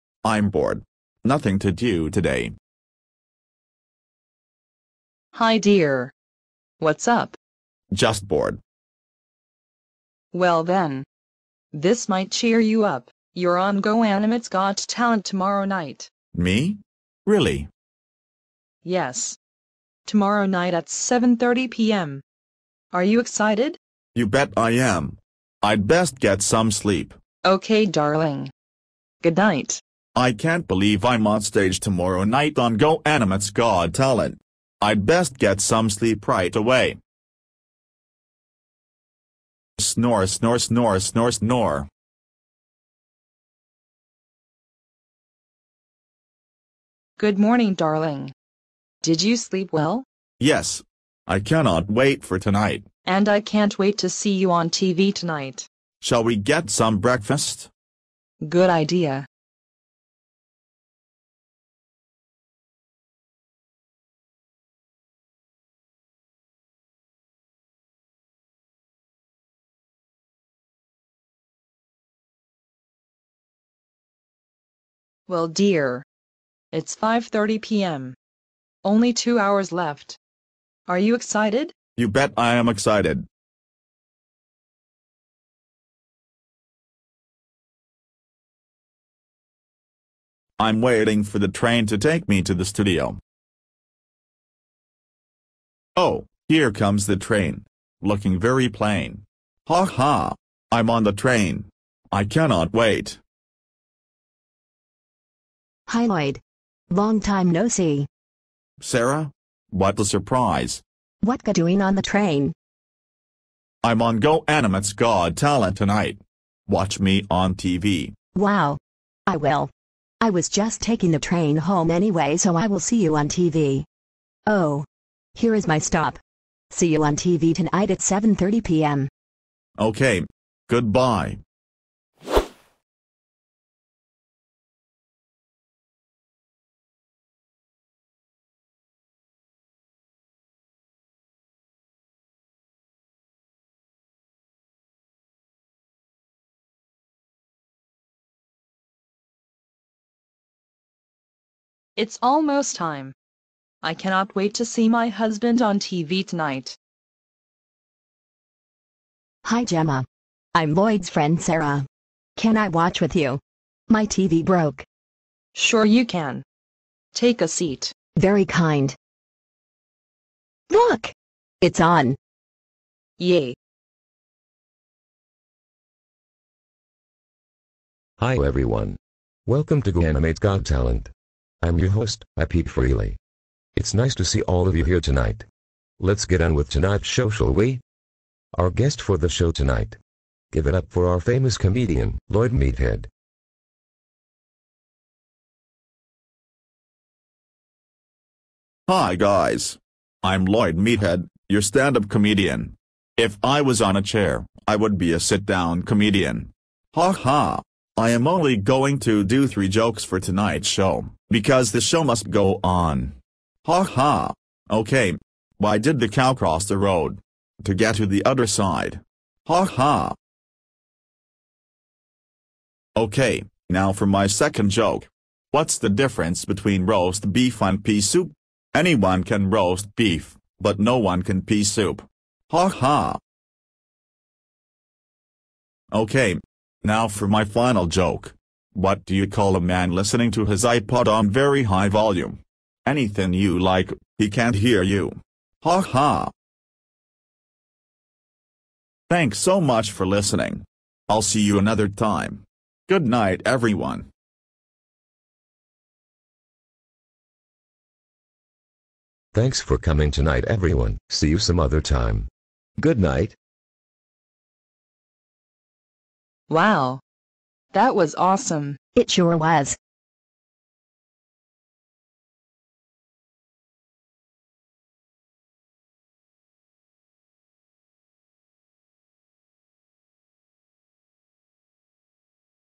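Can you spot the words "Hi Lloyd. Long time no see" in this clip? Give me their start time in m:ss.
1:45.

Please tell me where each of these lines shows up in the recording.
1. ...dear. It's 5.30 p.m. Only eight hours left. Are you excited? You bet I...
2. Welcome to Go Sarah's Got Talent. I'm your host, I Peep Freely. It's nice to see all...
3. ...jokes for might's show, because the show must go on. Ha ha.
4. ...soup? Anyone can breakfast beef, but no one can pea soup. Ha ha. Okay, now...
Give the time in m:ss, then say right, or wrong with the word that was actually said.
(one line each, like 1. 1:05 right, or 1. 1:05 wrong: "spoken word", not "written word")
1. 1:15 wrong: "two", not "eight"
2. 2:59 wrong: "Animate", not "Sarah"
3. 3:29 wrong: "tonight", not "might"
4. 3:48 wrong: "roast", not "breakfast".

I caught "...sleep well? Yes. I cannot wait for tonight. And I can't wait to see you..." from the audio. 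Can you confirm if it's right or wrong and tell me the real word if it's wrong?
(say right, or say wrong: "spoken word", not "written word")
right.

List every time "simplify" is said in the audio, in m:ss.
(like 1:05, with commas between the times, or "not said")
not said.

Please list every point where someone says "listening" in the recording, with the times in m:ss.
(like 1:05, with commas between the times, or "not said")
3:59, 4:10.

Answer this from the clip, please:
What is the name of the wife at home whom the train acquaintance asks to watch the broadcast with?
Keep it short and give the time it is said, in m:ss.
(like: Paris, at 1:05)
Gemma, at 2:39.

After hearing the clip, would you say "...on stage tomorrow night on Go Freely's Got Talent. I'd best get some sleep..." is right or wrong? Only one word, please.
wrong.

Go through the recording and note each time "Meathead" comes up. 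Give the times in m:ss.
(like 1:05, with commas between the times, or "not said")
3:12, 3:20.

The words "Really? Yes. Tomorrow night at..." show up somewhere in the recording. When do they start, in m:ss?
0:17.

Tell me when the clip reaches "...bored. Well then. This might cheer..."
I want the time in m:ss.
0:08.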